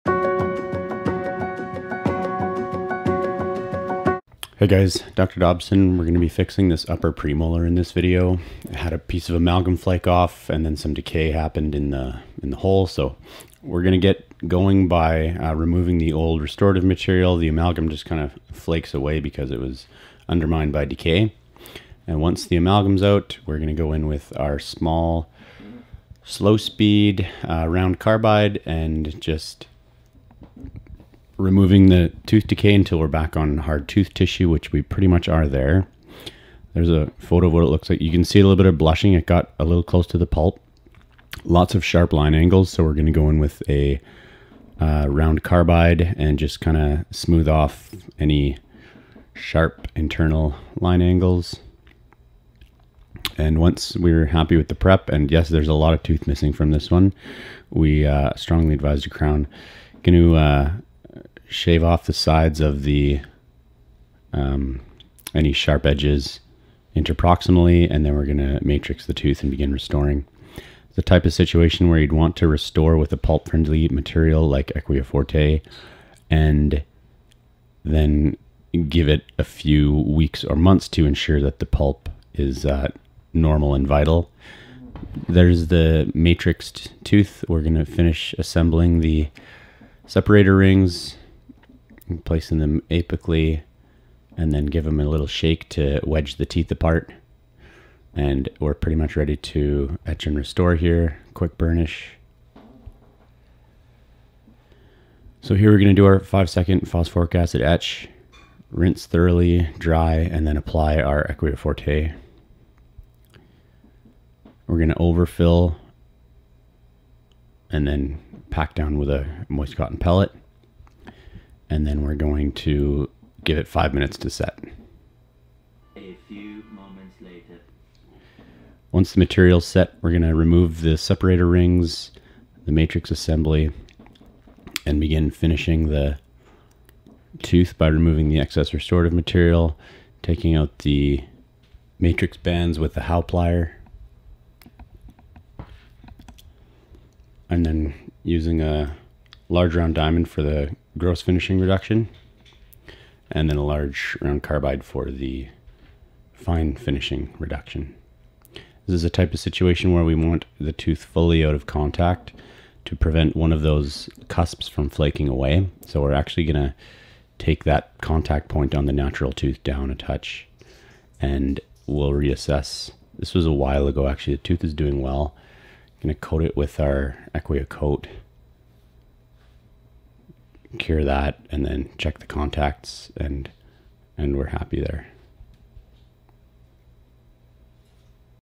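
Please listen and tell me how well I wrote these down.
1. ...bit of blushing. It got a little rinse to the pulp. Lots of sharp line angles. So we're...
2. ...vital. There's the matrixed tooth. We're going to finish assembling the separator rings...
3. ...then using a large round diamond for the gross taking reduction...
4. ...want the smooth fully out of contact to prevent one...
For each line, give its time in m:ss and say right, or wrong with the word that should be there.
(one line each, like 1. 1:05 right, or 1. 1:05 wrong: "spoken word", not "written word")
1. 0:38 wrong: "close", not "rinse"
2. 1:23 right
3. 2:27 wrong: "finishing", not "taking"
4. 2:40 wrong: "tooth", not "smooth".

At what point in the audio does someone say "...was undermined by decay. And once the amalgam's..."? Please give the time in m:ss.
0:19.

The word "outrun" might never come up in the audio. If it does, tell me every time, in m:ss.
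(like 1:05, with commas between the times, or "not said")
not said.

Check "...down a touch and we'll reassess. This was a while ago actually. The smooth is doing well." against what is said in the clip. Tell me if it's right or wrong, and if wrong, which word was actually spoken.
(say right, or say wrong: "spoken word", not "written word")
wrong: "tooth", not "smooth".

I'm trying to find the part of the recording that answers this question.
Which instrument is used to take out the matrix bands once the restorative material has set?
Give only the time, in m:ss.
2:23.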